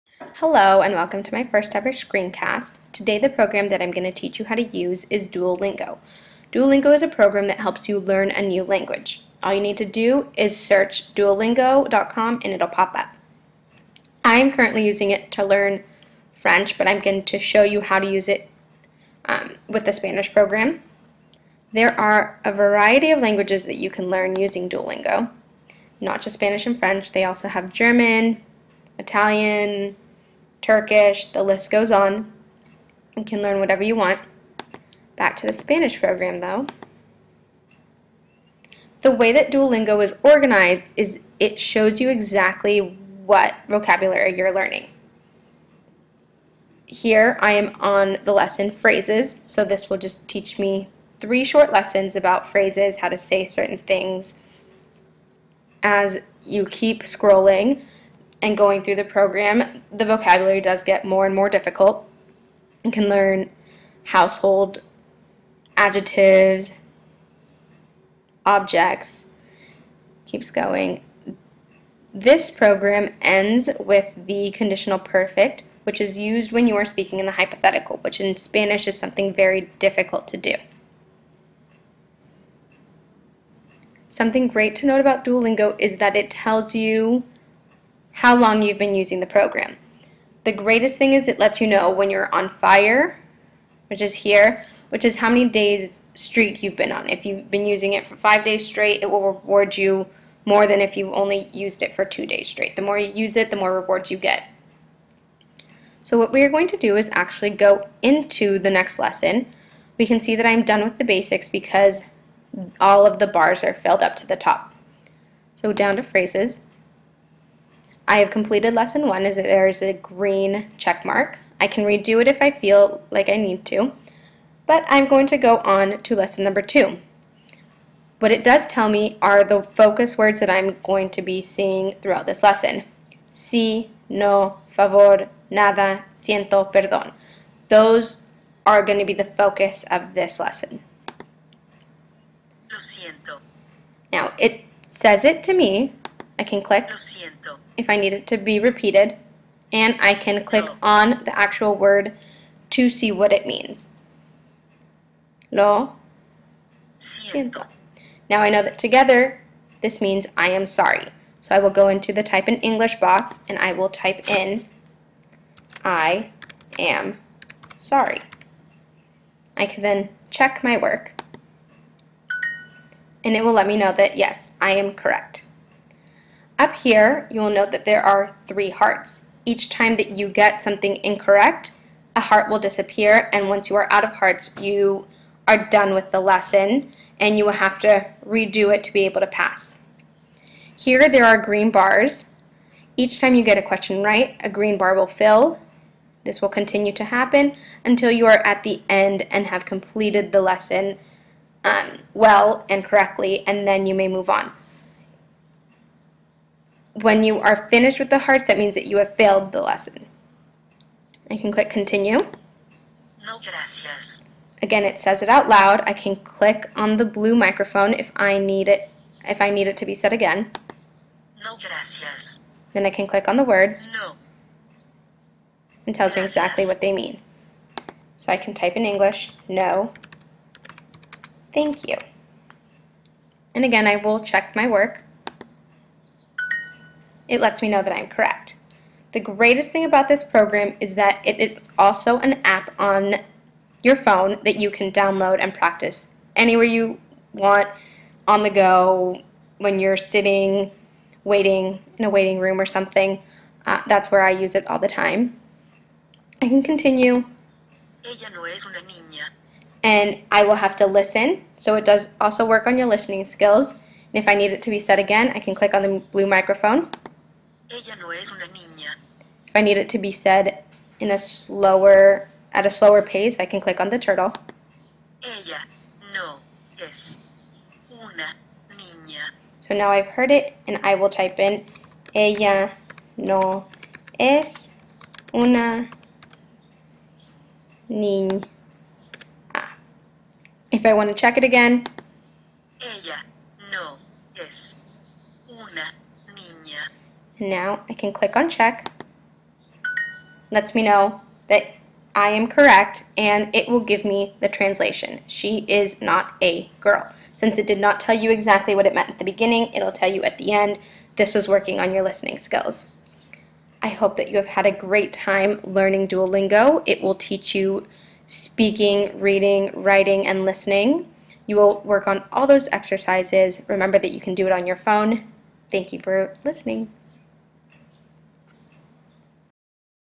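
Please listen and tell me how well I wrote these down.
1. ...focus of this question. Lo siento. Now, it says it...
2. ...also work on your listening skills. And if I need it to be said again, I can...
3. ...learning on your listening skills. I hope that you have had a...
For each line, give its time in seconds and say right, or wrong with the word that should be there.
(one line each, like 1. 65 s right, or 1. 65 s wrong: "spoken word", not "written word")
1. 139 s wrong: "lesson", not "question"
2. 262 s right
3. 311 s wrong: "working", not "learning".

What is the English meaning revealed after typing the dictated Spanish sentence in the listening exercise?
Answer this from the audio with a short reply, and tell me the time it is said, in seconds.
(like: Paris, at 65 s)
She is not a girl, at 305 s.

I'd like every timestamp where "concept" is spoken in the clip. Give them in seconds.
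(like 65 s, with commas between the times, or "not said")
not said.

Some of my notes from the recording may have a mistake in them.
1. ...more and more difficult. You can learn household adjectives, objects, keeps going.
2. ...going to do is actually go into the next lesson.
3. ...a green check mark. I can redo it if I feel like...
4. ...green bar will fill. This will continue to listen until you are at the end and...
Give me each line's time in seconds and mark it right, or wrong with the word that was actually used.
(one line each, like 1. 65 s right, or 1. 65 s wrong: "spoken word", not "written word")
1. 61 s right
2. 106 s right
3. 119 s right
4. 194 s wrong: "happen", not "listen".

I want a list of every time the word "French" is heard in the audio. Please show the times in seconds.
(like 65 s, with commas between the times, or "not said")
16 s, 26 s.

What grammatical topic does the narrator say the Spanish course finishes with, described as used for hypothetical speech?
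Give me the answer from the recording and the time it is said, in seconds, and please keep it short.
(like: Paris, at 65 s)
conditional perfect, at 74 s.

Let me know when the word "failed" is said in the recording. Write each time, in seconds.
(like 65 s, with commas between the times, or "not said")
209 s.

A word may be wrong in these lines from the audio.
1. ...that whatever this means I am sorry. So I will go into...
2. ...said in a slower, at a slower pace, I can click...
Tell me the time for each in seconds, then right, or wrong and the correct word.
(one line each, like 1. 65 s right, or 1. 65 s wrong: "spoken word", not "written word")
1. 158 s wrong: "together", not "whatever"
2. 270 s right.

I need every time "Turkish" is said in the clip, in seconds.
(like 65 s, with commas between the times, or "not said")
30 s.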